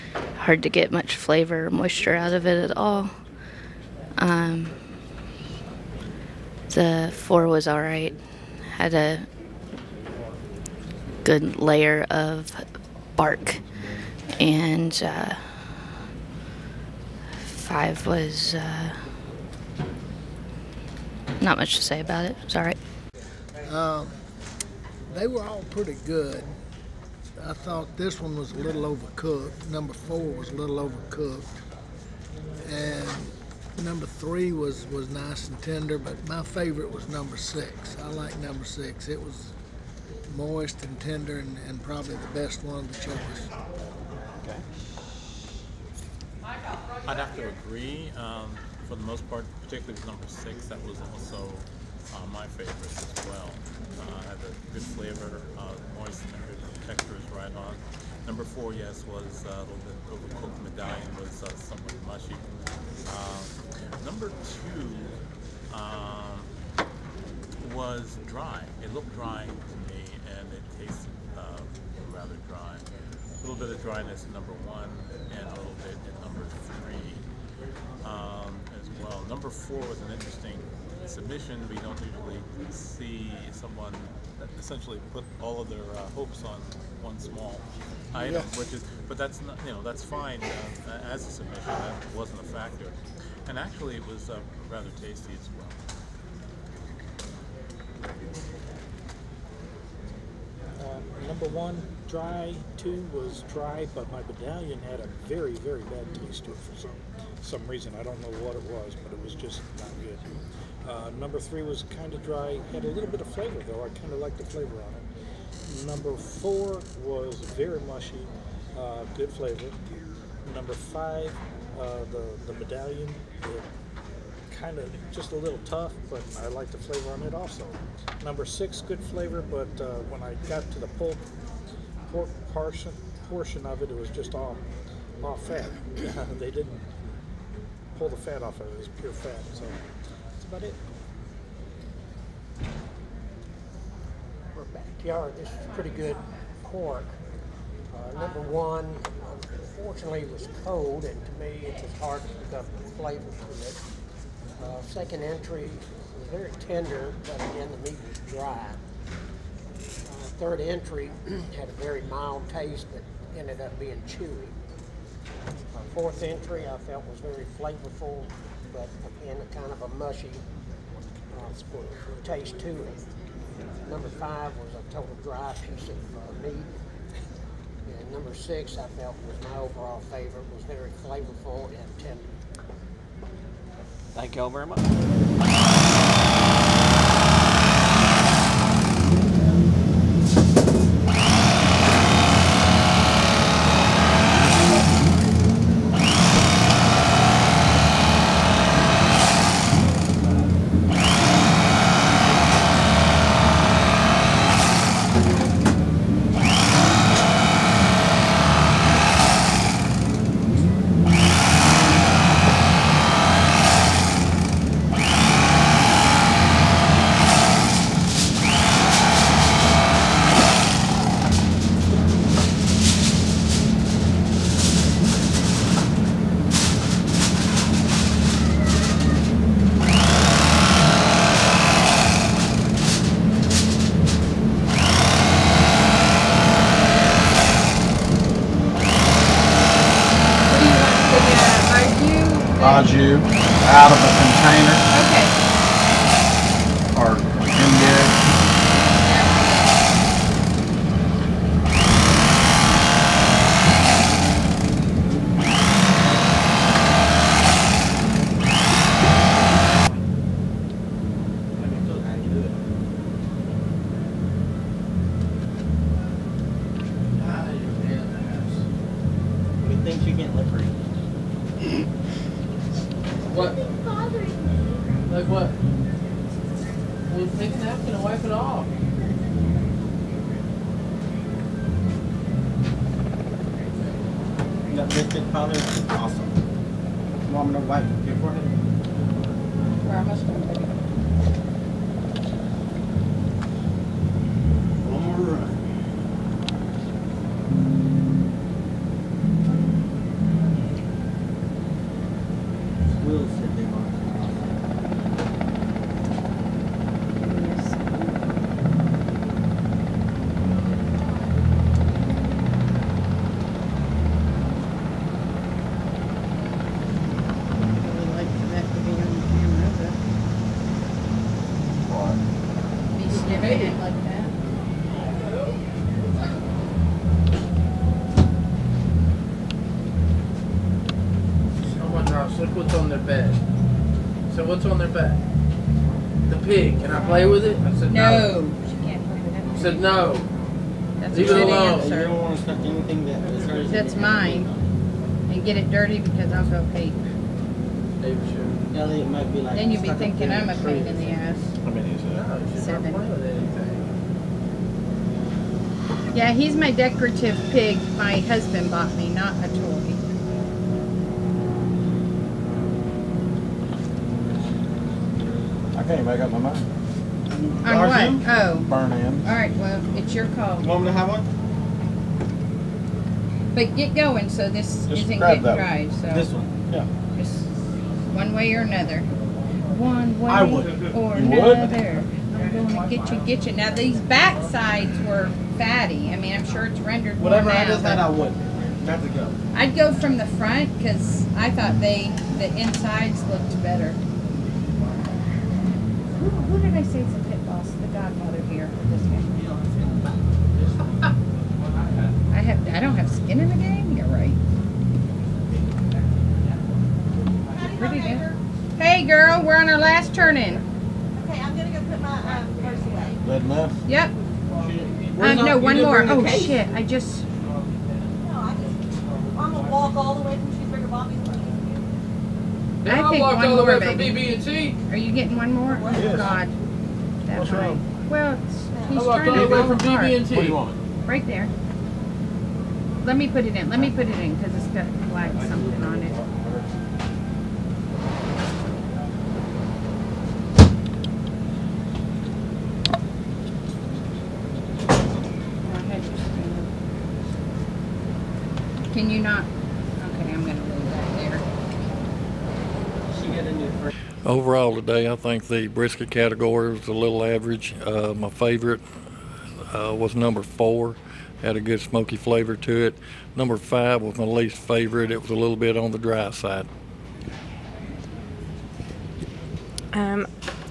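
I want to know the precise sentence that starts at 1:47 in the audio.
I don't know what it was, but it was just not good.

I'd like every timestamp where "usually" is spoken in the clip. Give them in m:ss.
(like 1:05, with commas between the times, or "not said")
1:22.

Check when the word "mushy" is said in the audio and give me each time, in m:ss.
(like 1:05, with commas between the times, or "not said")
1:02, 1:57, 2:49.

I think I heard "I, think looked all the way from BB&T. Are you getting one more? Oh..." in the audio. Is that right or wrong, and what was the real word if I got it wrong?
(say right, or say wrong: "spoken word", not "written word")
wrong: "walked", not "looked".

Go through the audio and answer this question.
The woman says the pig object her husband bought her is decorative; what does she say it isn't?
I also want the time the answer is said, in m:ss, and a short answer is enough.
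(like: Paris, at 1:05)
a toy, at 5:59.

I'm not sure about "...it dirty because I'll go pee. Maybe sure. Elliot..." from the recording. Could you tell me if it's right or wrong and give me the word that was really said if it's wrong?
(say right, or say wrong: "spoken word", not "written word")
right.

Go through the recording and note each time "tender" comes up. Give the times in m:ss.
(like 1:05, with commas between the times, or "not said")
0:35, 0:40, 2:36, 3:01.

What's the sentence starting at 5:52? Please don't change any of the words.
No, you should not play with anything.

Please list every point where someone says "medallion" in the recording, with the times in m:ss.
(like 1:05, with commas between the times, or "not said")
1:00, 1:44, 2:02.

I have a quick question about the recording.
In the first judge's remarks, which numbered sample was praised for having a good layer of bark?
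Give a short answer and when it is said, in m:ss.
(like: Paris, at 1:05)
4, at 0:06.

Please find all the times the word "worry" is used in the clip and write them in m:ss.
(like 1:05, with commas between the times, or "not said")
not said.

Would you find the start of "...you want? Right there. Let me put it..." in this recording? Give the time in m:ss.
7:10.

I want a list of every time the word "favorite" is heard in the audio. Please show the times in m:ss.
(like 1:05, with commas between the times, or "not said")
0:36, 0:52, 3:00, 7:38, 7:44.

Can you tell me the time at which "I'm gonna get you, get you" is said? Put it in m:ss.
6:22.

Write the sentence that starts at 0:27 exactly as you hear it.
I thought this one was a little overcooked.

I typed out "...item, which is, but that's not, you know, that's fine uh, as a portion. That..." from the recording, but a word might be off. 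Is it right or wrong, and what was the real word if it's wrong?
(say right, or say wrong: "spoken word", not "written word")
wrong: "submission", not "portion".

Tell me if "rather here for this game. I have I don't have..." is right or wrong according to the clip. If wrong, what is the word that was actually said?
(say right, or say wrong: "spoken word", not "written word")
wrong: "godmother", not "rather".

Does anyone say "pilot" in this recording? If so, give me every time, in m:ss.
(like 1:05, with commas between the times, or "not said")
not said.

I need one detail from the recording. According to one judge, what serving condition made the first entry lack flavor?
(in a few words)
it was cold.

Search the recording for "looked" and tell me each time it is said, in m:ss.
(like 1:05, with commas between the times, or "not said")
1:08, 6:33.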